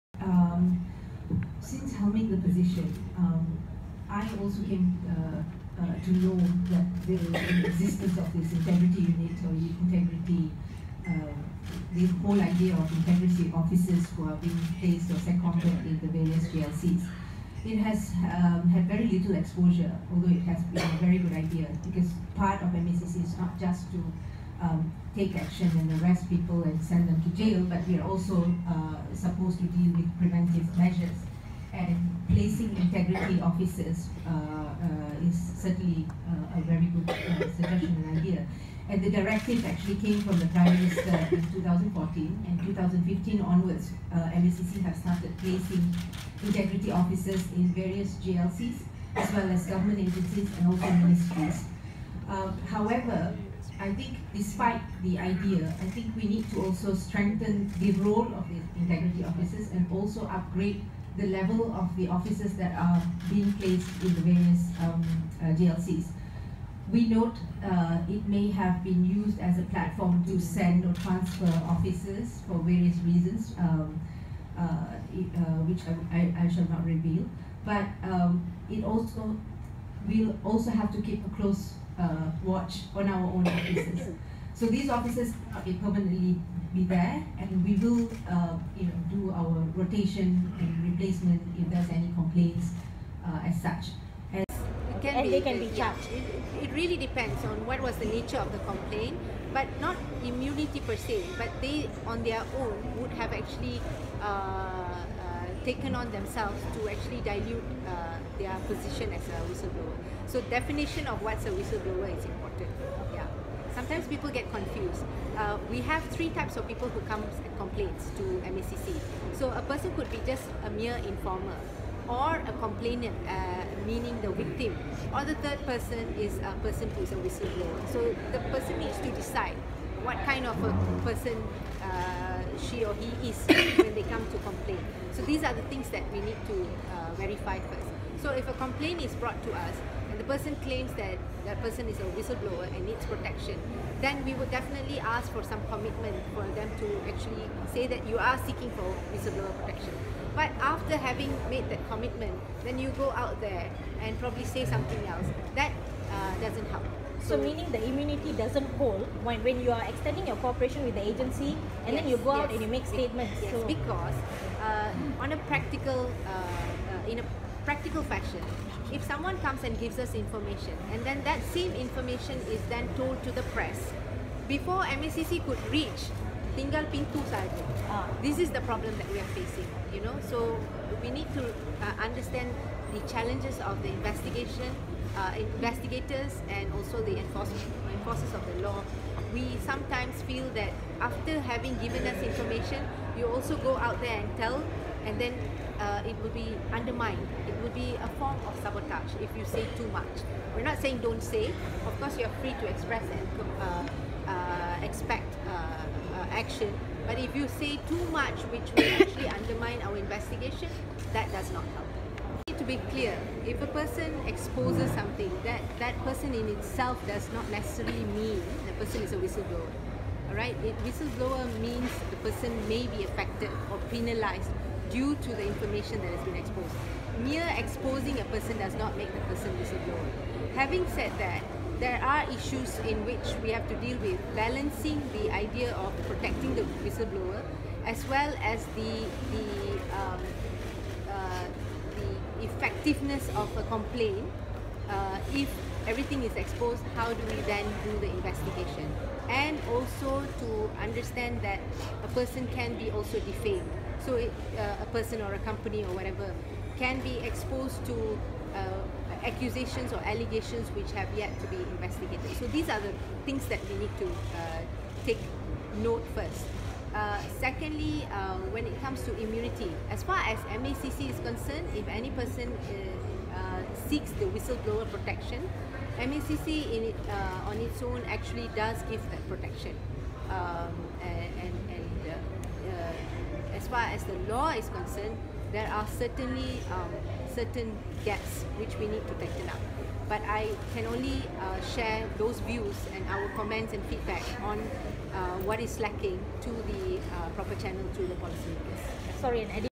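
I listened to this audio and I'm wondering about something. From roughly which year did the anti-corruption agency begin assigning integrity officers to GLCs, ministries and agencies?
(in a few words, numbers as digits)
2015.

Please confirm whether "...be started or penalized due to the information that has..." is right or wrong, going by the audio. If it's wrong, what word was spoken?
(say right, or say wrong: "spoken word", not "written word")
wrong: "affected", not "started".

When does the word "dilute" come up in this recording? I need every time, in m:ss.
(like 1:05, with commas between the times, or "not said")
1:47.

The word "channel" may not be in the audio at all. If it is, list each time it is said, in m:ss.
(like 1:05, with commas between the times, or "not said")
4:57.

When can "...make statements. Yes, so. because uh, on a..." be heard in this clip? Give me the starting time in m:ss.
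2:42.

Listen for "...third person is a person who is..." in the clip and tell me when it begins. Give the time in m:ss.
2:05.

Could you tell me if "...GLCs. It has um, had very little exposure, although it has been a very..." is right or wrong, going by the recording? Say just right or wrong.
right.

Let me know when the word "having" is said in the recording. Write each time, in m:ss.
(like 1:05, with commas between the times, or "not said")
2:30, 3:11, 3:50.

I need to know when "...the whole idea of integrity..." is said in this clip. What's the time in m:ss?
0:11.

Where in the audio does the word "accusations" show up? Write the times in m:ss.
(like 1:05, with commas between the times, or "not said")
4:19.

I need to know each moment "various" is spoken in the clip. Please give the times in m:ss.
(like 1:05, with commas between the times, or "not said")
0:16, 0:47, 1:04, 1:12.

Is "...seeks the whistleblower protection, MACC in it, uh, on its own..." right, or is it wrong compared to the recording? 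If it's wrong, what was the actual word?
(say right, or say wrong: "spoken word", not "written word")
right.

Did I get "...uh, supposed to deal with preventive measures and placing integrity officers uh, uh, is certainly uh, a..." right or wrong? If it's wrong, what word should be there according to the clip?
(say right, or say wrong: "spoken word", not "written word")
right.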